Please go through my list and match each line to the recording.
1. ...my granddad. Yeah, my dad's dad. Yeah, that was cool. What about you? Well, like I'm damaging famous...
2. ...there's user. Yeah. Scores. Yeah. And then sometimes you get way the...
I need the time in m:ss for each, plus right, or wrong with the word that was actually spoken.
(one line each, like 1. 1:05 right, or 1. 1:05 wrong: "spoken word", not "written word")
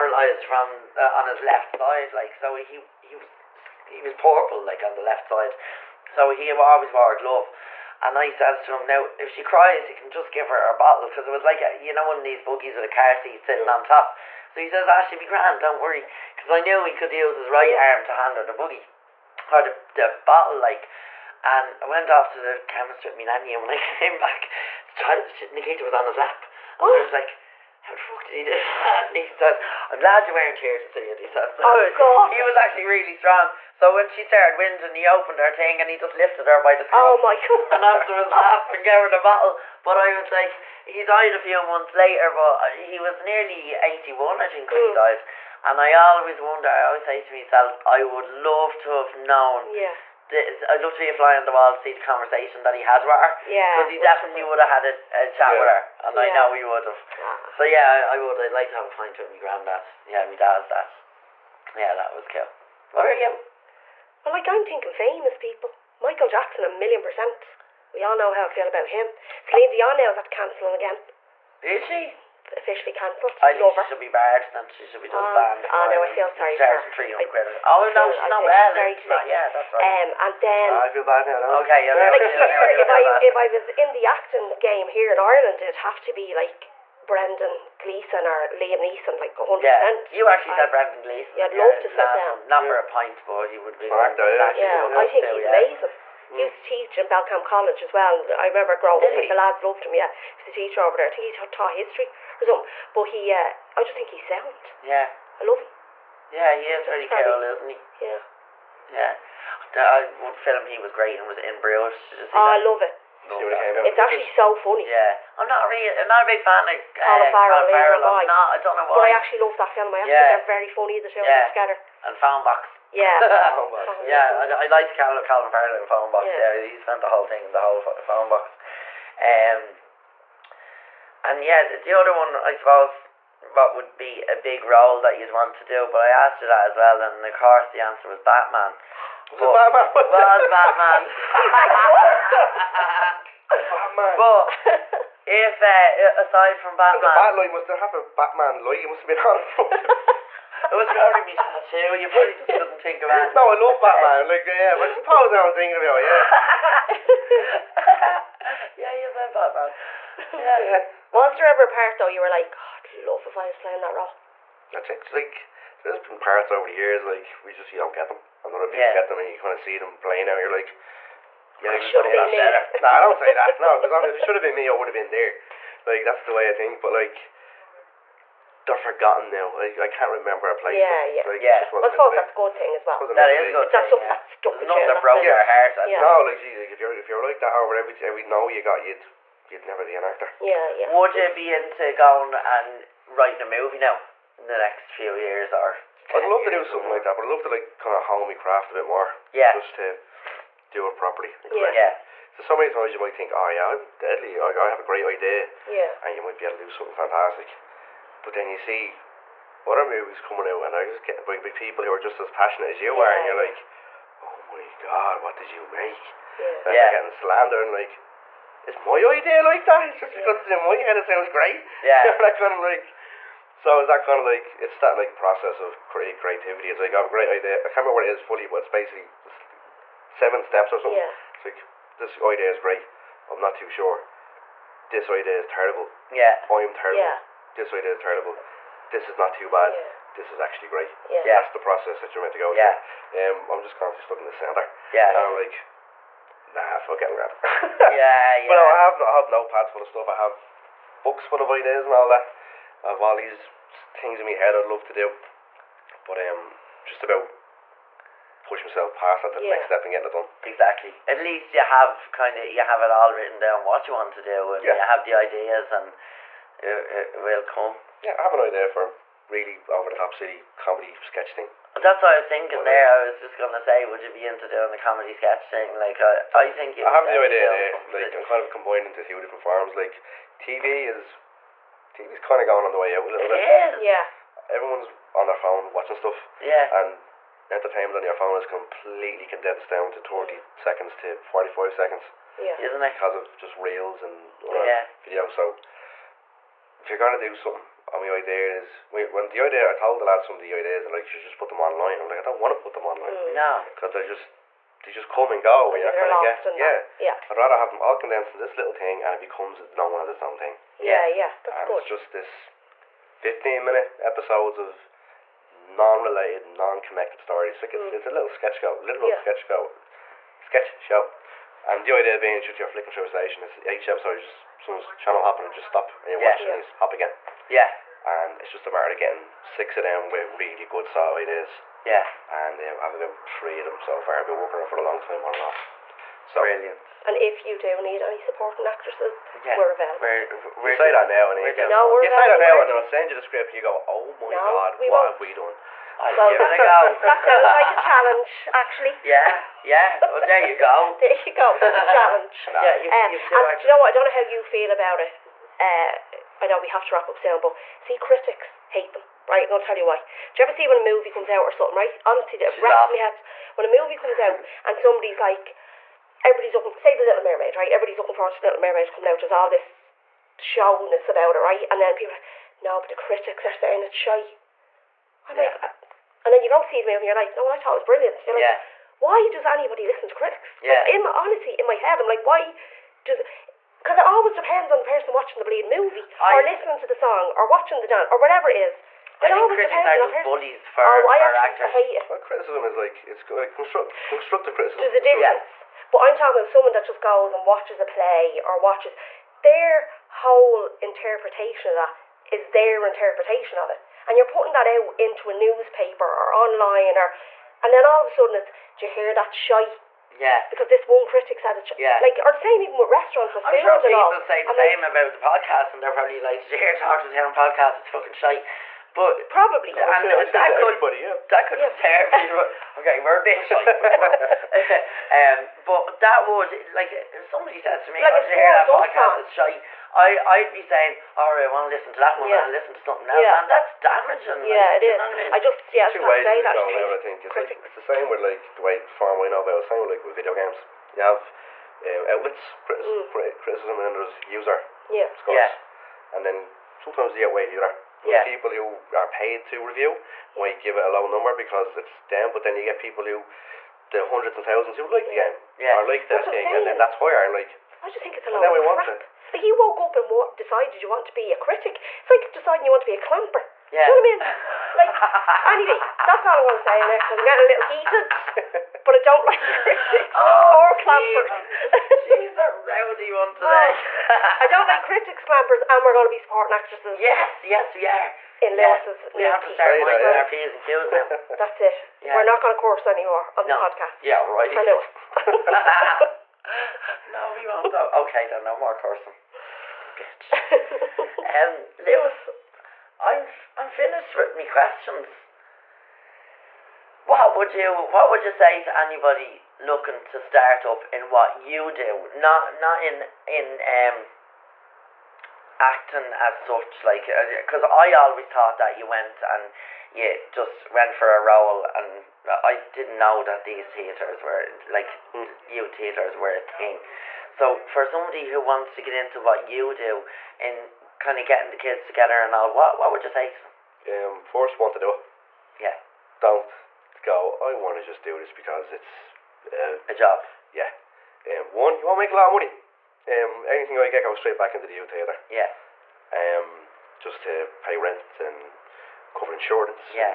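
1. 0:59 wrong: "thinking", not "damaging"
2. 7:23 right.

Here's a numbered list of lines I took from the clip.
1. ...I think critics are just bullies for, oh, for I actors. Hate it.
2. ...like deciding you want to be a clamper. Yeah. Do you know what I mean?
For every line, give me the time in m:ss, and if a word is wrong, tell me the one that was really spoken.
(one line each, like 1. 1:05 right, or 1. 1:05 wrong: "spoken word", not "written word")
1. 6:29 right
2. 7:42 right.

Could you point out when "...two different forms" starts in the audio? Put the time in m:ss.
4:39.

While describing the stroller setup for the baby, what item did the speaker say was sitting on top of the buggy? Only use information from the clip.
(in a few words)
car seat.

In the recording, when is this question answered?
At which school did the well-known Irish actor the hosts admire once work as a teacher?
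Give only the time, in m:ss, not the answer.
1:37.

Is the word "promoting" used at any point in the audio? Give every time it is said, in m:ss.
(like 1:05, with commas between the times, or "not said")
not said.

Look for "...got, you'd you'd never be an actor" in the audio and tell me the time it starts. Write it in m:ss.
3:08.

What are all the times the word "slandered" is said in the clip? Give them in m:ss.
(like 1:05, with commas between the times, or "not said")
3:37.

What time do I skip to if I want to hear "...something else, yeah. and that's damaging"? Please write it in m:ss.
7:12.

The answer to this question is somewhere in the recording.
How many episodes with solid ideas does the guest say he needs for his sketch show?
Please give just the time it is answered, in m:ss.
5:29.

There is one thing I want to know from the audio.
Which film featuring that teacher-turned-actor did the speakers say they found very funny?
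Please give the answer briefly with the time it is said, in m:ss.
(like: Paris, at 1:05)
In Bruges, at 1:51.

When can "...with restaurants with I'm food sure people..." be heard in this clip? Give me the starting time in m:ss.
6:52.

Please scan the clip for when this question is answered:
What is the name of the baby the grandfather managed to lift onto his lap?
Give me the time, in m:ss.
0:25.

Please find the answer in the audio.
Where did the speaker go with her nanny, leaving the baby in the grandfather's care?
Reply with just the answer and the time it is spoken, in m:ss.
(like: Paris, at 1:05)
the chemist, at 0:22.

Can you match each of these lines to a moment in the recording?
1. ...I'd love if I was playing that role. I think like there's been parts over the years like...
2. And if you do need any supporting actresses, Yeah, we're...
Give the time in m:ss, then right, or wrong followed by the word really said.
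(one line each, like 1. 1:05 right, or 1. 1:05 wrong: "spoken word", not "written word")
1. 2:42 right
2. 5:37 right.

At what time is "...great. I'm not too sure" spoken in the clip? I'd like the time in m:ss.
3:52.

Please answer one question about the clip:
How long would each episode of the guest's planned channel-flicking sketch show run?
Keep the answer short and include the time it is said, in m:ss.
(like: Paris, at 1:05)
15 minutes, at 5:13.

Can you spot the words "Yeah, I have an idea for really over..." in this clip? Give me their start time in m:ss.
4:28.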